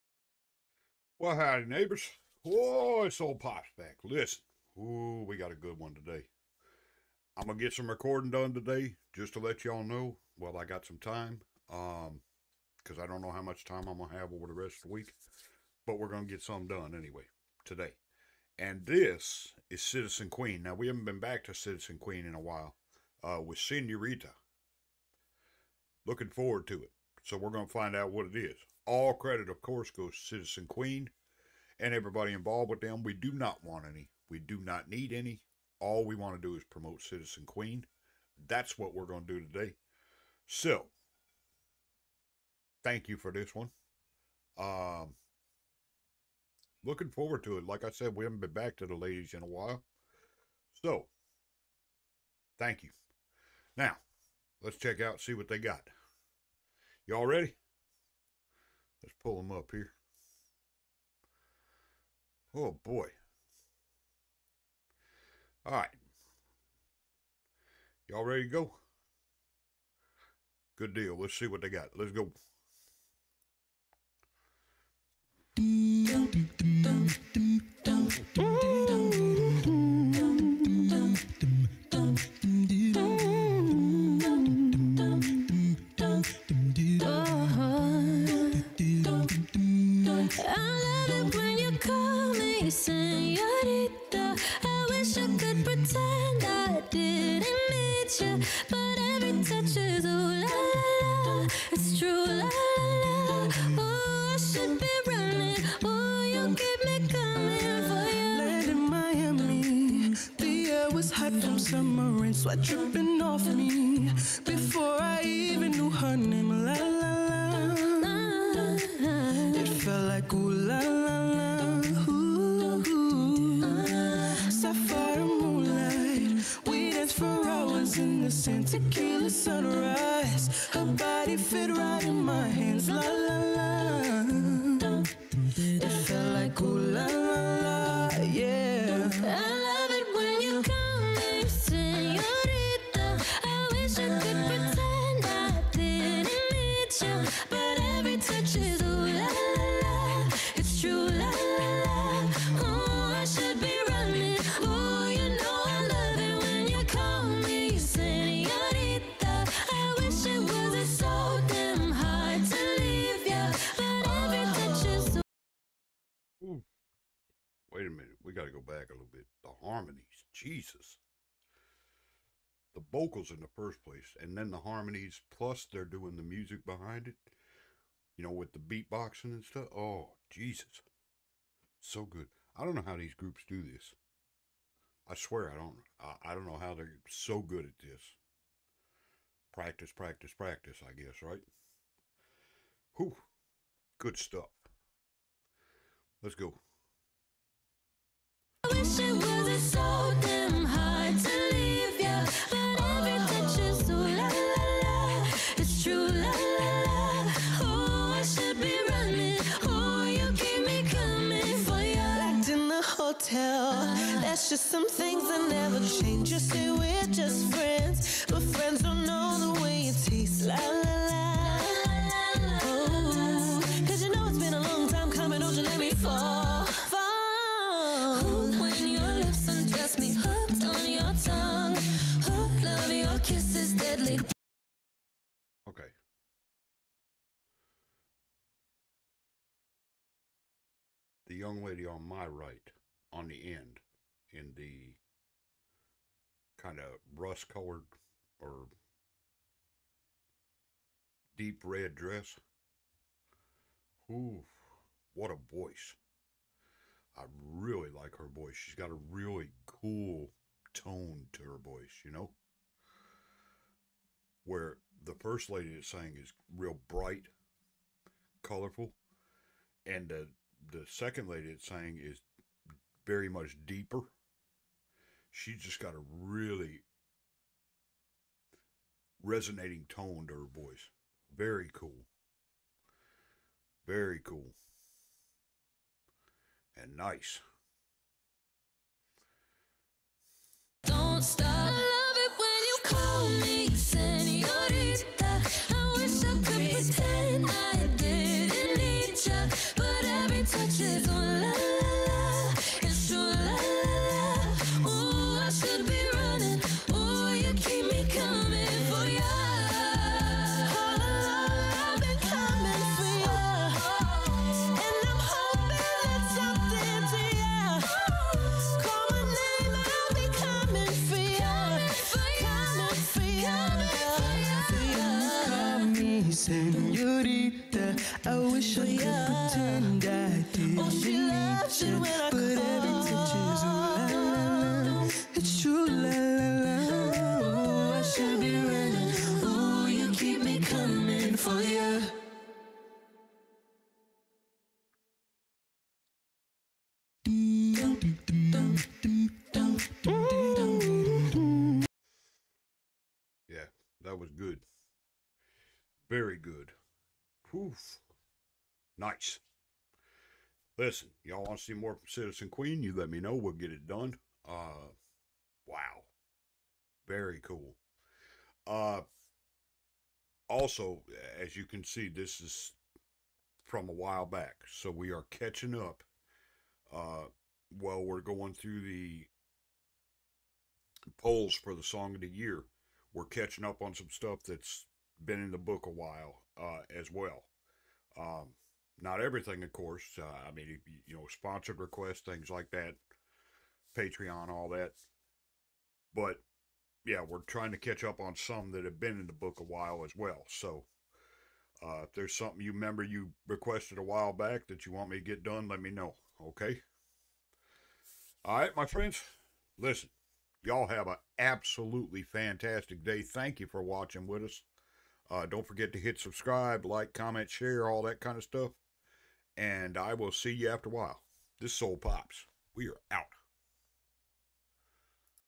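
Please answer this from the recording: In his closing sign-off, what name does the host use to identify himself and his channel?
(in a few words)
Soul Pops.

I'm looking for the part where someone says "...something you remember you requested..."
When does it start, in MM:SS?
06:42.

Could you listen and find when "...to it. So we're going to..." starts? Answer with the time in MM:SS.
00:26.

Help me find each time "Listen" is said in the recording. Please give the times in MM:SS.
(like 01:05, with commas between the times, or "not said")
00:04, 06:00, 06:49.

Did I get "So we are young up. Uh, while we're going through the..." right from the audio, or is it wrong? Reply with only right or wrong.
wrong.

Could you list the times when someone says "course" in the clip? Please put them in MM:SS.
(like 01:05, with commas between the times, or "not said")
00:29, 06:29.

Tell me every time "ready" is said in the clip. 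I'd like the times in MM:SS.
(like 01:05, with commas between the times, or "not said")
00:57, 01:08.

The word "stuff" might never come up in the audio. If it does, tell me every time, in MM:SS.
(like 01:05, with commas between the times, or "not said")
02:59, 03:14, 06:24, 06:58.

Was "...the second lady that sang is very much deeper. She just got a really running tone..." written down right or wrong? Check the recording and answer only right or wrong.
wrong.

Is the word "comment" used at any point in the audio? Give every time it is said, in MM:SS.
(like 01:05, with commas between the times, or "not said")
06:57.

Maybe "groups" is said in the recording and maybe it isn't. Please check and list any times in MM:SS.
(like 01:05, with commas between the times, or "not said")
03:03.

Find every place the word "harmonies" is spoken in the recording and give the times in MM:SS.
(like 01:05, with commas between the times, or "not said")
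02:49, 02:54.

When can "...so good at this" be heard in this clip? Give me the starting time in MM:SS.
03:07.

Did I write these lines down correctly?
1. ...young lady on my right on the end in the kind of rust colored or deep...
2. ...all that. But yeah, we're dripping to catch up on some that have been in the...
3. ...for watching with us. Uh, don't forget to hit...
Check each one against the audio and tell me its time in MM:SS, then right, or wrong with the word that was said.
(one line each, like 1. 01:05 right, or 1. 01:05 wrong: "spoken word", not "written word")
1. 04:01 right
2. 06:34 wrong: "trying", not "dripping"
3. 06:53 right.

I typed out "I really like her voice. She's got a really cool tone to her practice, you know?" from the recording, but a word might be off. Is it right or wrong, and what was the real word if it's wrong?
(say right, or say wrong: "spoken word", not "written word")
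wrong: "voice", not "practice".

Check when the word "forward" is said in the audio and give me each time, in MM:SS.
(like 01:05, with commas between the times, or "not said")
00:26, 00:47.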